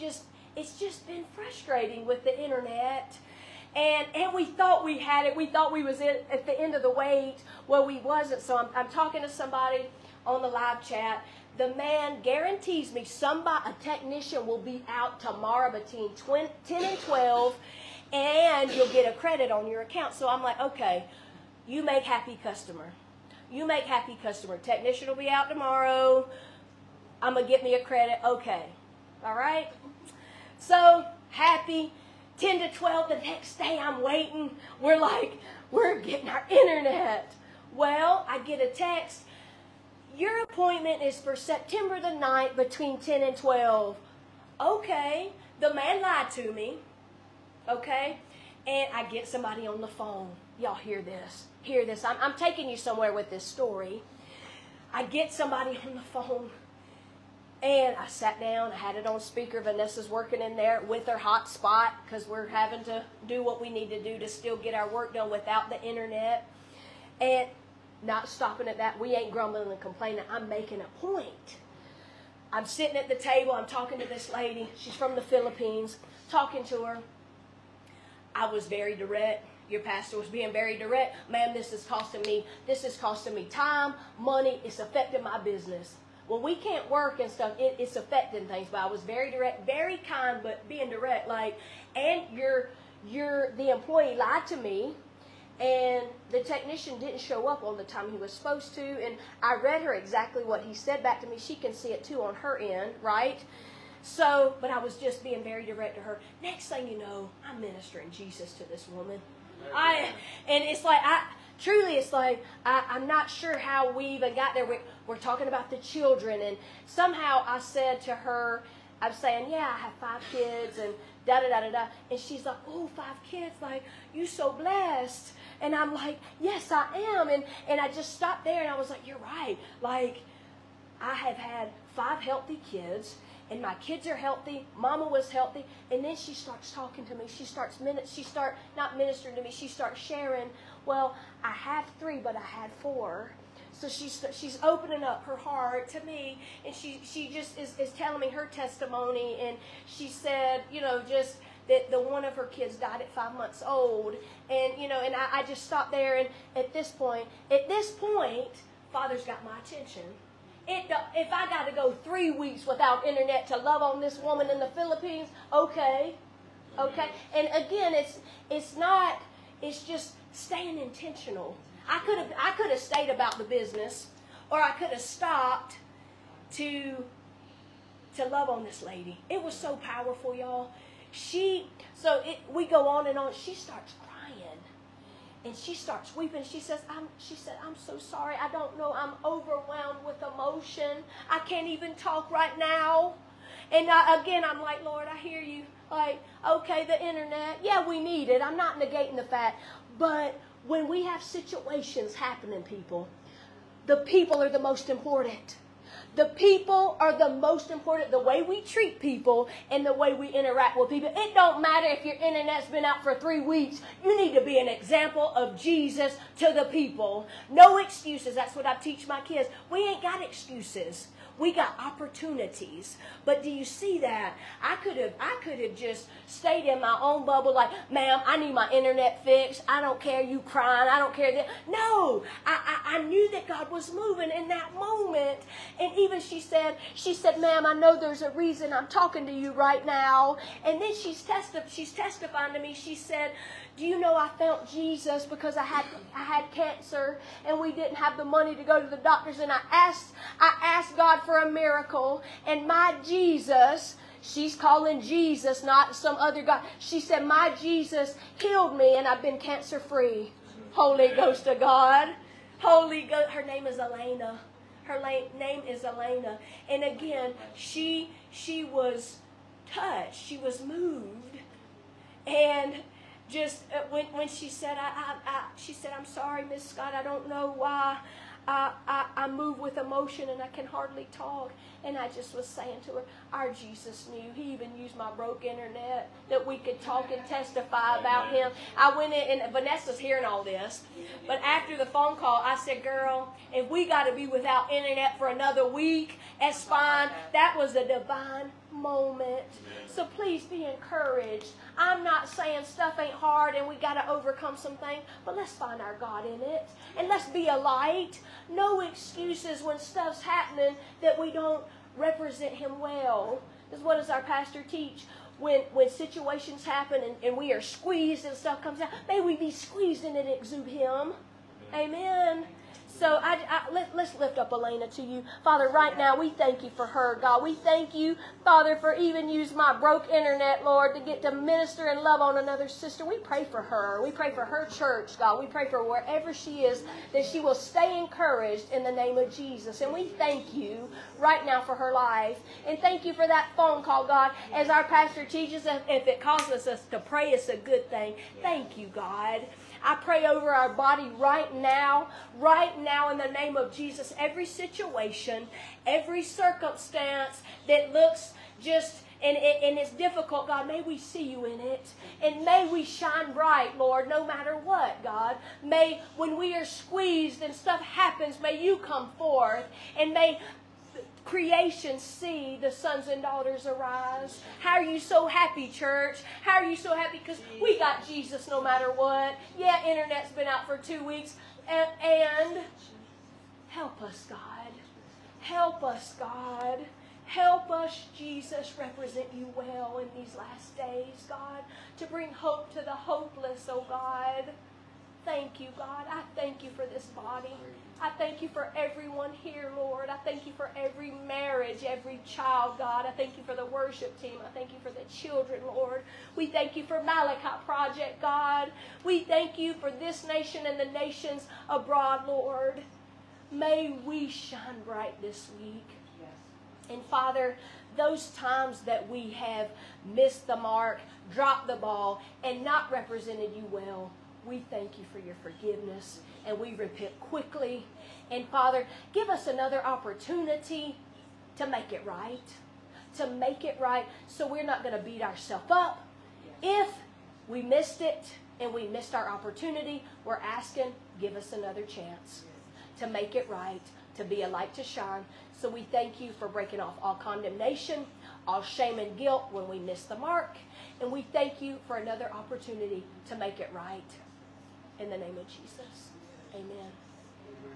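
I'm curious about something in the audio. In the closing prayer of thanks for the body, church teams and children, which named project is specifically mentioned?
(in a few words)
Malachi Project.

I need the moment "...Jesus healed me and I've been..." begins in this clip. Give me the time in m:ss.
4:17.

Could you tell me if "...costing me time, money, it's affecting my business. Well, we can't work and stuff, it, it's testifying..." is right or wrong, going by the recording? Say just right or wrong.
wrong.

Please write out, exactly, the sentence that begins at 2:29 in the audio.
And she said, you know, just that the one of her kids died at five months old.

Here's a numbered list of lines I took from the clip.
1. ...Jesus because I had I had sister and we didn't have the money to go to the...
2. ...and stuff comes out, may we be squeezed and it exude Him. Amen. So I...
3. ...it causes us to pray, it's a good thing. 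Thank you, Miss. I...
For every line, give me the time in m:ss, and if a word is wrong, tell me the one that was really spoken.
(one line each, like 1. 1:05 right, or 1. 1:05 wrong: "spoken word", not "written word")
1. 4:04 wrong: "cancer", not "sister"
2. 5:18 right
3. 5:46 wrong: "God", not "Miss".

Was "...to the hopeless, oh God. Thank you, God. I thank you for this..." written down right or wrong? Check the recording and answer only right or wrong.
right.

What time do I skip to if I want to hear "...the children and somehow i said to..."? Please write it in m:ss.
1:55.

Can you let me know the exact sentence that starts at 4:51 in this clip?
But after the phone call, I said, Girl, if we got to be without internet for another week, that's fine.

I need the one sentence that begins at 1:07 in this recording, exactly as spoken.
And not stopping at that, we ain't grumbling and complaining.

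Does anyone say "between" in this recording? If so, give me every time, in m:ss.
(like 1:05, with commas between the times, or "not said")
0:15, 0:42.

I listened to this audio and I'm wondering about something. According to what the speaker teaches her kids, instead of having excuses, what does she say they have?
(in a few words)
opportunities.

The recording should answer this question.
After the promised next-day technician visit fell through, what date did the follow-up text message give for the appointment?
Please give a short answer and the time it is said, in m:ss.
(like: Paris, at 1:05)
September 9, at 0:41.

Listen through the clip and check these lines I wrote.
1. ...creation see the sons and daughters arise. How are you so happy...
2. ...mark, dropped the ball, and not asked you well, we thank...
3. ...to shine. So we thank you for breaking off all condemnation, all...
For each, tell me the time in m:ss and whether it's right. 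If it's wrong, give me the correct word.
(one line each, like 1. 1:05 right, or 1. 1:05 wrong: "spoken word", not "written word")
1. 6:11 right
2. 7:00 wrong: "represented", not "asked"
3. 7:24 right.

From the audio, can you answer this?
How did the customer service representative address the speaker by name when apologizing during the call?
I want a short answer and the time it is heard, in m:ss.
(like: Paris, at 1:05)
Miss Scott, at 4:36.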